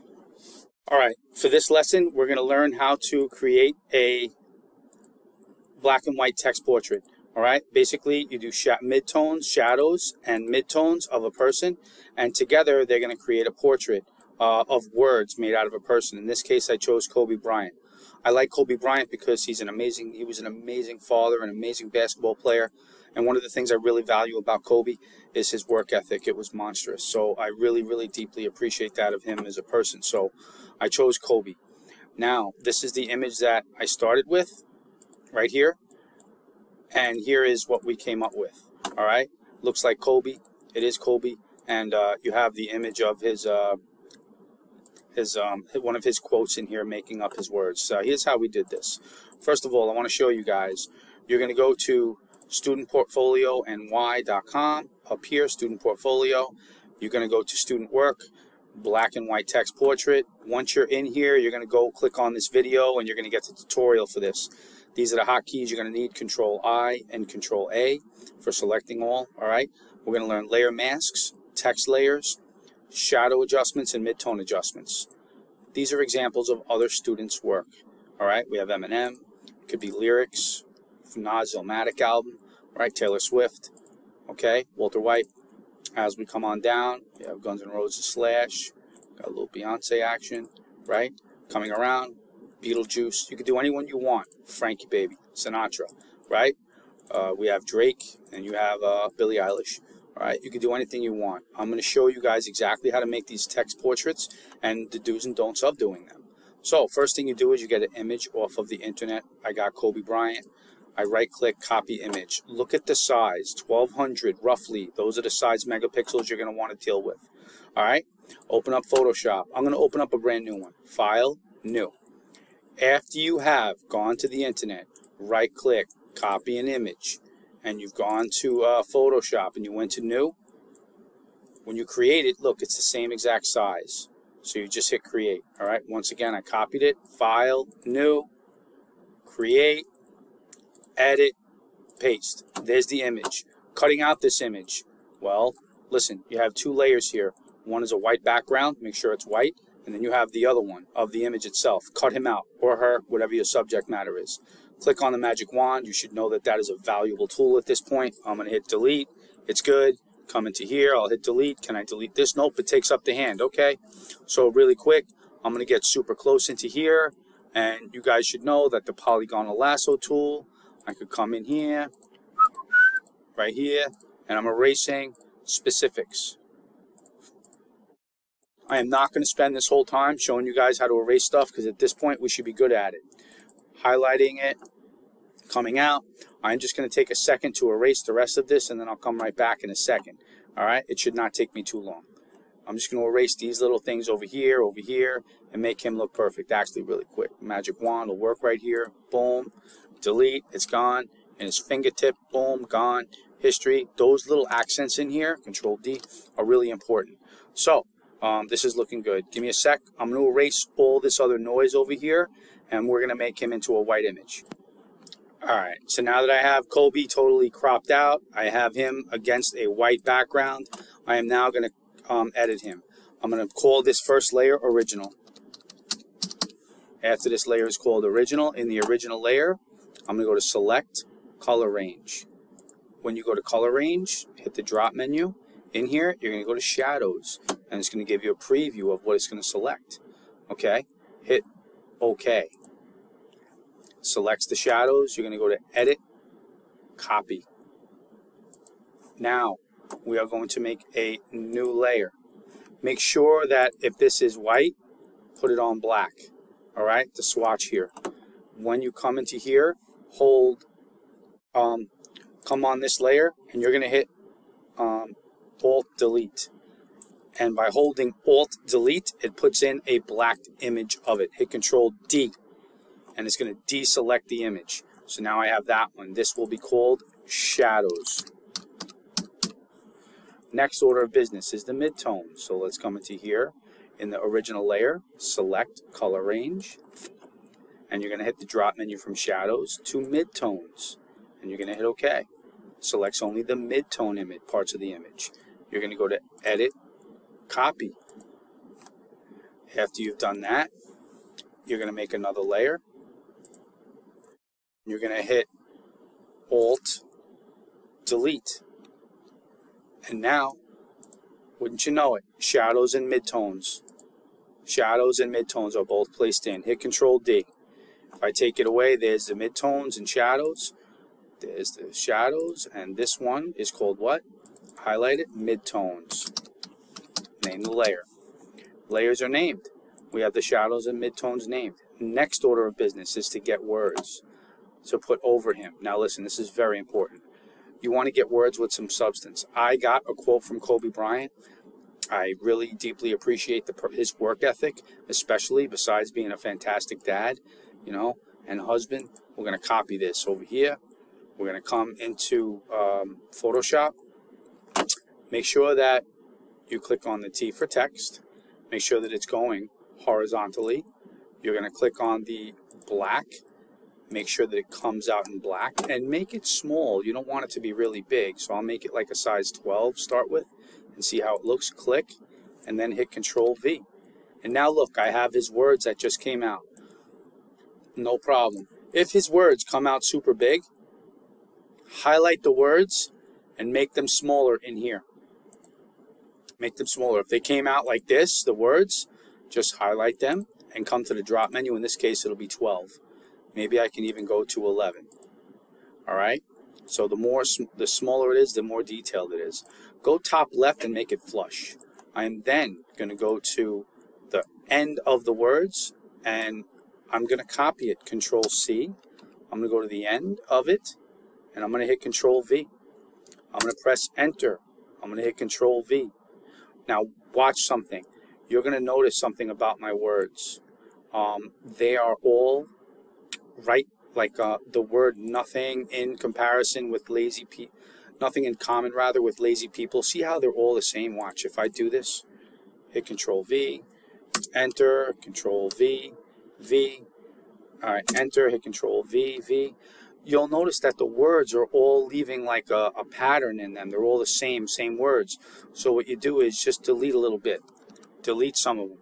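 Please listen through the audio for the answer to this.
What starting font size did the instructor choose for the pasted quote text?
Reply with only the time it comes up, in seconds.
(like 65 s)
369 s.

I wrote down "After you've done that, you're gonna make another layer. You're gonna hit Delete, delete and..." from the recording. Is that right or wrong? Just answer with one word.
wrong.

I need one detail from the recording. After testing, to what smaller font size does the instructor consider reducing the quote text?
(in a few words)
11.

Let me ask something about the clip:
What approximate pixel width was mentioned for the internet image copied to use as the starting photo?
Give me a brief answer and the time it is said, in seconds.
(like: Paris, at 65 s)
1200, at 113 s.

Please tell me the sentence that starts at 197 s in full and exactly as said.
Magic wand will work right here.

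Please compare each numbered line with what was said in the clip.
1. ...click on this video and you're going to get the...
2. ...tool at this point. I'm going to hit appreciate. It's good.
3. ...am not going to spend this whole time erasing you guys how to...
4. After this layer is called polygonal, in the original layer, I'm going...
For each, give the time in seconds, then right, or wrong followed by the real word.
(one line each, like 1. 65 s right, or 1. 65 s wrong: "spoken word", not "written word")
1. 61 s right
2. 157 s wrong: "delete", not "appreciate"
3. 178 s wrong: "showing", not "erasing"
4. 227 s wrong: "original", not "polygonal".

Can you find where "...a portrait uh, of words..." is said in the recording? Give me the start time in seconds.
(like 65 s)
13 s.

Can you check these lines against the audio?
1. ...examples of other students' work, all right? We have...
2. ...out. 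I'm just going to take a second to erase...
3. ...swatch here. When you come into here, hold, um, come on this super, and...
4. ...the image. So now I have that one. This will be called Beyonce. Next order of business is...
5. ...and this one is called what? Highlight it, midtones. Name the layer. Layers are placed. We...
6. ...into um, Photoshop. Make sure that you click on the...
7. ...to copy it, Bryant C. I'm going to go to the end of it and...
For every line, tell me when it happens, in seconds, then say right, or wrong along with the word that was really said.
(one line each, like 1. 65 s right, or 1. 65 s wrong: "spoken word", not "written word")
1. 76 s right
2. 185 s right
3. 257 s wrong: "layer", not "super"
4. 274 s wrong: "Shadows", not "Beyonce"
5. 322 s wrong: "named", not "placed"
6. 351 s right
7. 407 s wrong: "Control", not "Bryant".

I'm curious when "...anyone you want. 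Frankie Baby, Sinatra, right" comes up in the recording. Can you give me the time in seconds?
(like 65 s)
93 s.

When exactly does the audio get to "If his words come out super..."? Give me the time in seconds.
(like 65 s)
378 s.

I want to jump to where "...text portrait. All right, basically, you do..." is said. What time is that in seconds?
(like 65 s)
6 s.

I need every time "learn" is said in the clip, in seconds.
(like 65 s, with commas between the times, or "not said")
2 s, 70 s.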